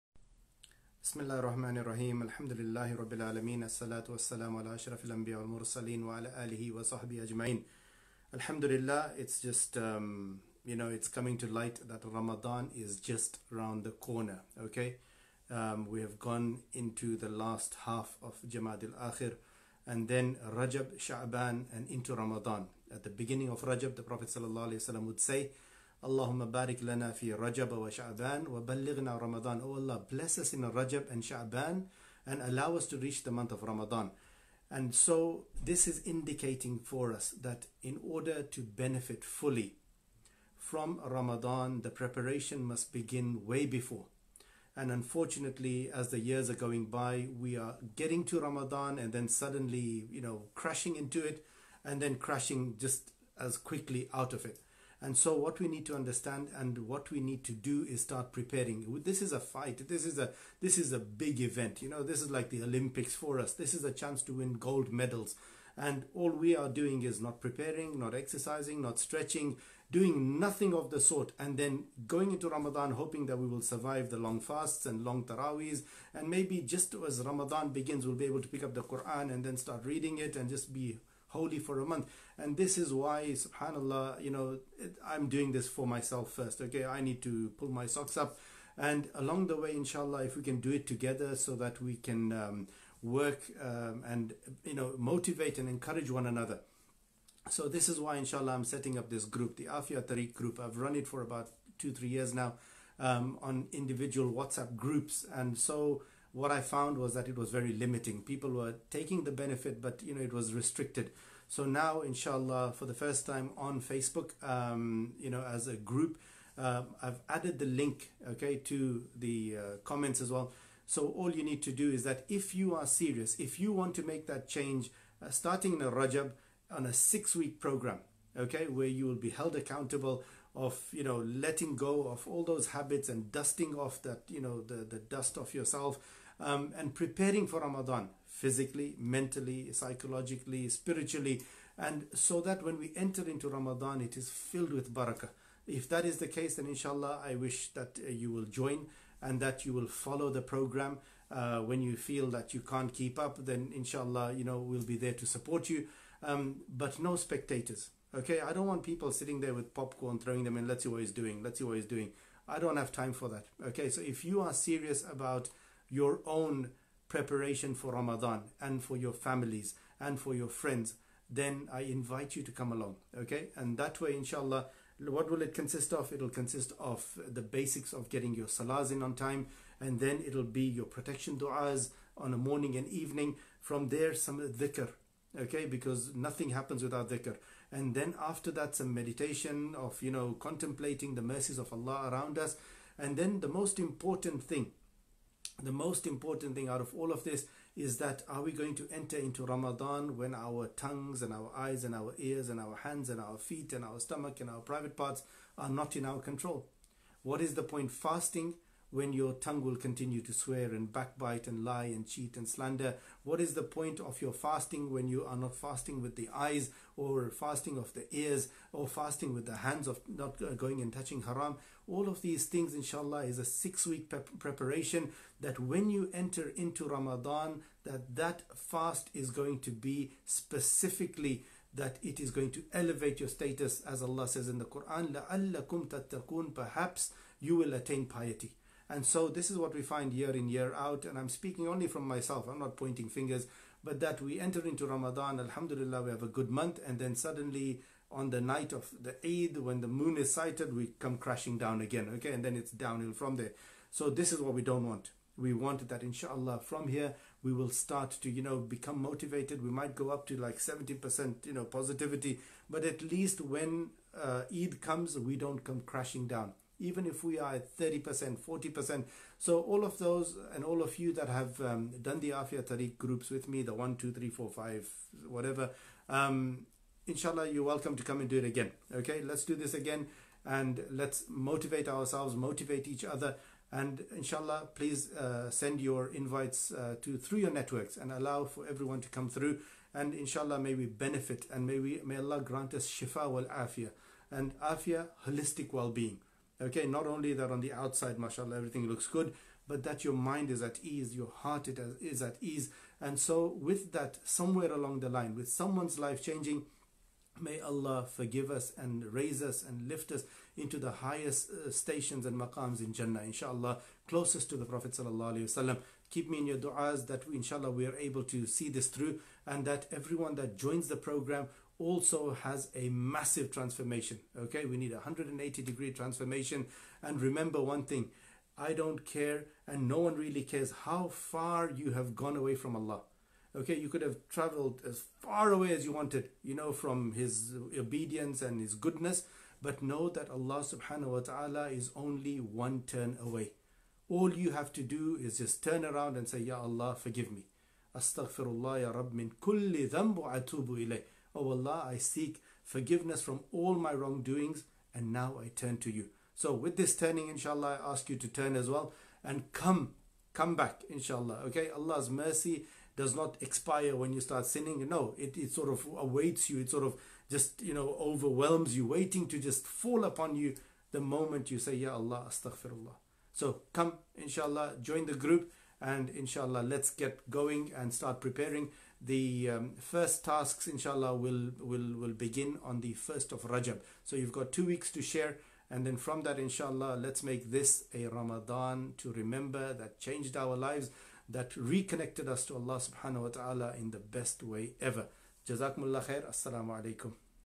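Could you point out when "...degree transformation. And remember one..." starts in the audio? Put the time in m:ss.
5:25.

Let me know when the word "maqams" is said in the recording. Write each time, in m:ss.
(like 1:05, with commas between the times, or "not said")
5:12.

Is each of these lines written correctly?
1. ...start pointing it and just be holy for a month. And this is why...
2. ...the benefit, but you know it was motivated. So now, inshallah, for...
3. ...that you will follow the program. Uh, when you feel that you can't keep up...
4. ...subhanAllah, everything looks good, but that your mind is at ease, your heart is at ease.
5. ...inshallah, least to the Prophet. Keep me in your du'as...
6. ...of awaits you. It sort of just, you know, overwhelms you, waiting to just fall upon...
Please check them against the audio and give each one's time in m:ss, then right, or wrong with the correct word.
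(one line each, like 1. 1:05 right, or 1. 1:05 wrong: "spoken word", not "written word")
1. 1:19 wrong: "reading", not "pointing"
2. 1:49 wrong: "restricted", not "motivated"
3. 2:29 right
4. 4:58 wrong: "mashallah", not "subhanAllah"
5. 5:13 wrong: "closest", not "least"
6. 6:05 right.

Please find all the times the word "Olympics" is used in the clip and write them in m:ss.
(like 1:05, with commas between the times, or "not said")
1:02.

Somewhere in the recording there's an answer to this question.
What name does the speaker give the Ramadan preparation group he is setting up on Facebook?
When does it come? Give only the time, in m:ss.
1:39.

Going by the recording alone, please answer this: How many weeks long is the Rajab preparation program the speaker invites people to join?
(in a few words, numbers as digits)
6.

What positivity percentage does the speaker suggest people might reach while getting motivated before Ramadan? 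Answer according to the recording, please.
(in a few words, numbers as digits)
70%.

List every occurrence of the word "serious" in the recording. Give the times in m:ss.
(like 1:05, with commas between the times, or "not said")
2:02, 2:44.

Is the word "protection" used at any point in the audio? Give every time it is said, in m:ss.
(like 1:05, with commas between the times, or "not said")
3:00.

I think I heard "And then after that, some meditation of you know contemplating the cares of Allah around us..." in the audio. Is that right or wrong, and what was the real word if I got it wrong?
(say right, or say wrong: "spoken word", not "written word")
wrong: "mercies", not "cares".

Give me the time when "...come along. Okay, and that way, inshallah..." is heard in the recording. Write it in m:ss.
2:52.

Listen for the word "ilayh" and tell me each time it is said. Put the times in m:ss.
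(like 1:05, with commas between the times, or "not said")
5:50.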